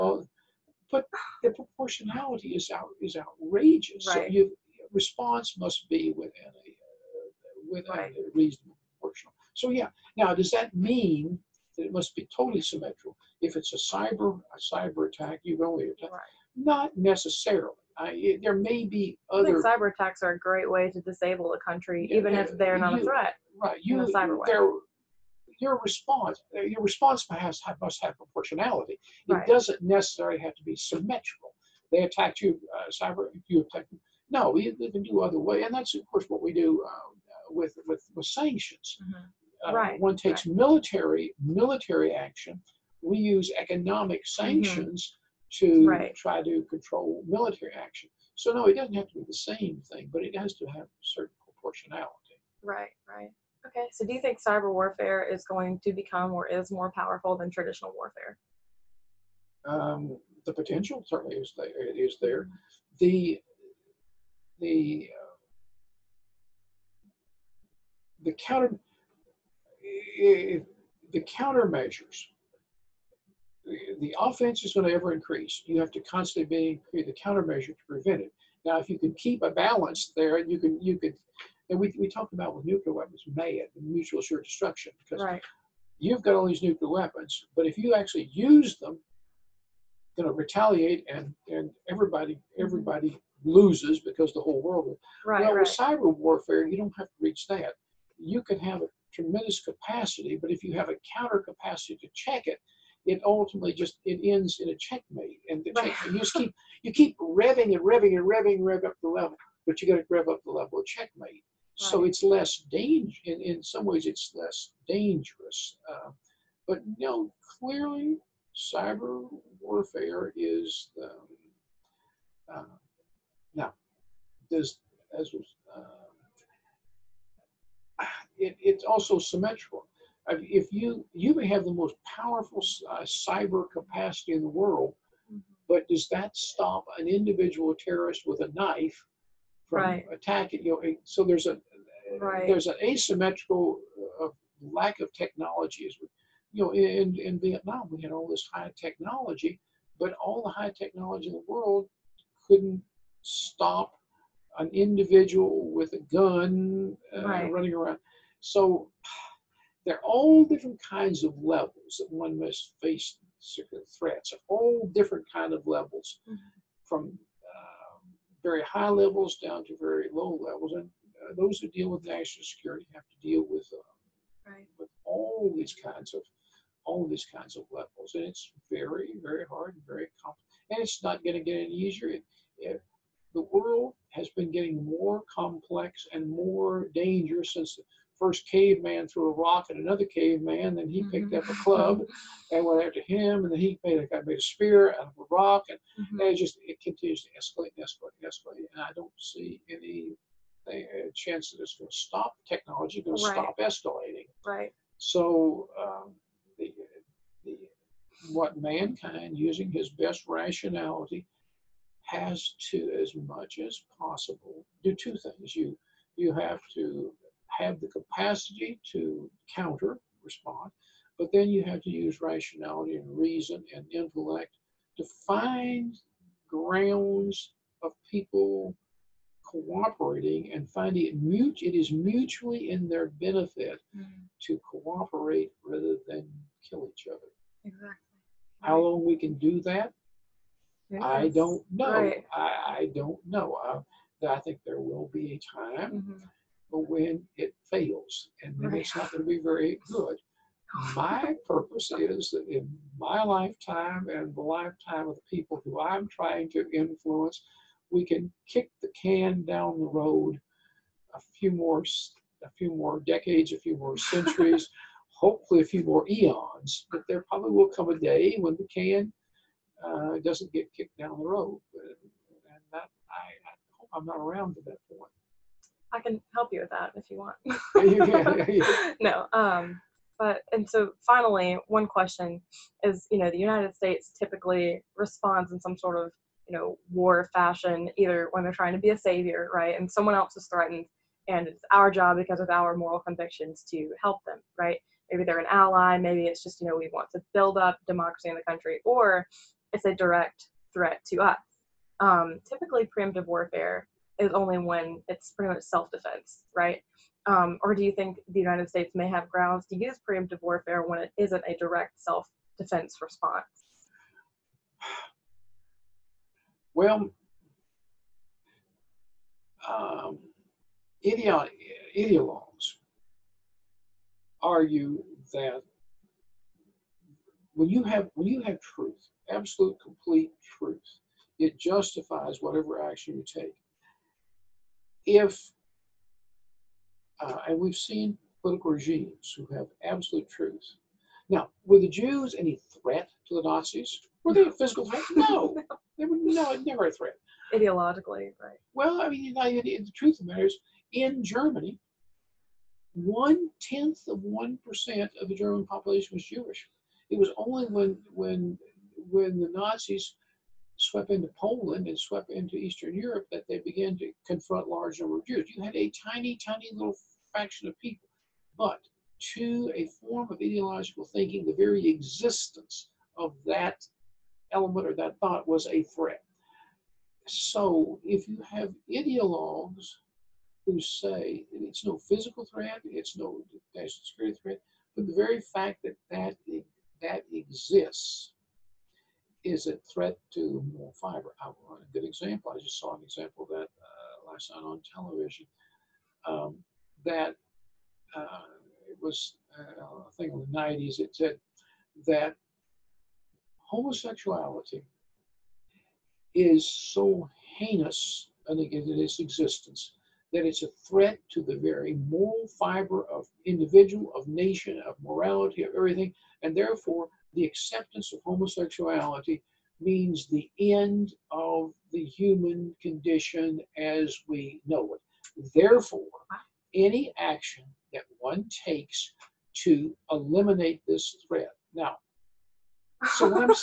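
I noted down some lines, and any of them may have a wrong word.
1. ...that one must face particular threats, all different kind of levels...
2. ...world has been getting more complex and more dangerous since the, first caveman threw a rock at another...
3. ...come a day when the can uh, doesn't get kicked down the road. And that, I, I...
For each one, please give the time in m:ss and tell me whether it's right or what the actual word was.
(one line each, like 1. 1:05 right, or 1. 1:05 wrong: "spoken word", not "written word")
1. 2:41 right
2. 3:03 right
3. 4:27 right.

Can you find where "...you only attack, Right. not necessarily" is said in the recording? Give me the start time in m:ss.
0:15.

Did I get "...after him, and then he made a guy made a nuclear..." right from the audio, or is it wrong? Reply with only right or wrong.
wrong.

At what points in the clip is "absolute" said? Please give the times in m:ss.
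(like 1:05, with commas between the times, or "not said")
5:29, 5:39.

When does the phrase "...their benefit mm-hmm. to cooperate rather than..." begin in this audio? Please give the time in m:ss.
3:52.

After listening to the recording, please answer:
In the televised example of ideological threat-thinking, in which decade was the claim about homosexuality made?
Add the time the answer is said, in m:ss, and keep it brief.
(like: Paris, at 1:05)
the 90s, at 6:40.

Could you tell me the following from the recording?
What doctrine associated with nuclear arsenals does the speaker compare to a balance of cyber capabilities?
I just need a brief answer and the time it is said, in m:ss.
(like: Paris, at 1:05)
mutual assured destruction, at 1:23.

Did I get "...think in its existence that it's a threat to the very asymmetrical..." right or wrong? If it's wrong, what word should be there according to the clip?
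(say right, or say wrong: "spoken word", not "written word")
wrong: "moral", not "asymmetrical".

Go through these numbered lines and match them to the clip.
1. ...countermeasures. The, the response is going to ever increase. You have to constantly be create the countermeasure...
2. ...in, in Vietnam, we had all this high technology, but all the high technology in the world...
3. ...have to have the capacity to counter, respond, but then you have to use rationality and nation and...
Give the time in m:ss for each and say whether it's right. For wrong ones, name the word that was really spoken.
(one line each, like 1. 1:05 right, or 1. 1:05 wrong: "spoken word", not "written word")
1. 1:11 wrong: "offense", not "response"
2. 2:26 right
3. 3:36 wrong: "reason", not "nation".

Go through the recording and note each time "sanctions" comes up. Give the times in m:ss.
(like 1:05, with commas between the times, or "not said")
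0:38, 0:44.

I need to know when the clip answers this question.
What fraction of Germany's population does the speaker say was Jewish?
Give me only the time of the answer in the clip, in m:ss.
5:52.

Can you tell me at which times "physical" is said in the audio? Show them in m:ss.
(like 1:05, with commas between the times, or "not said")
5:44, 6:21.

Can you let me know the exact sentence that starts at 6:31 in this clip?
want a good example, I just saw an example of that uh, last night on television.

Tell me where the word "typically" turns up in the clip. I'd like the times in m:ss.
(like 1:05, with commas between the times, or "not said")
4:44, 5:02.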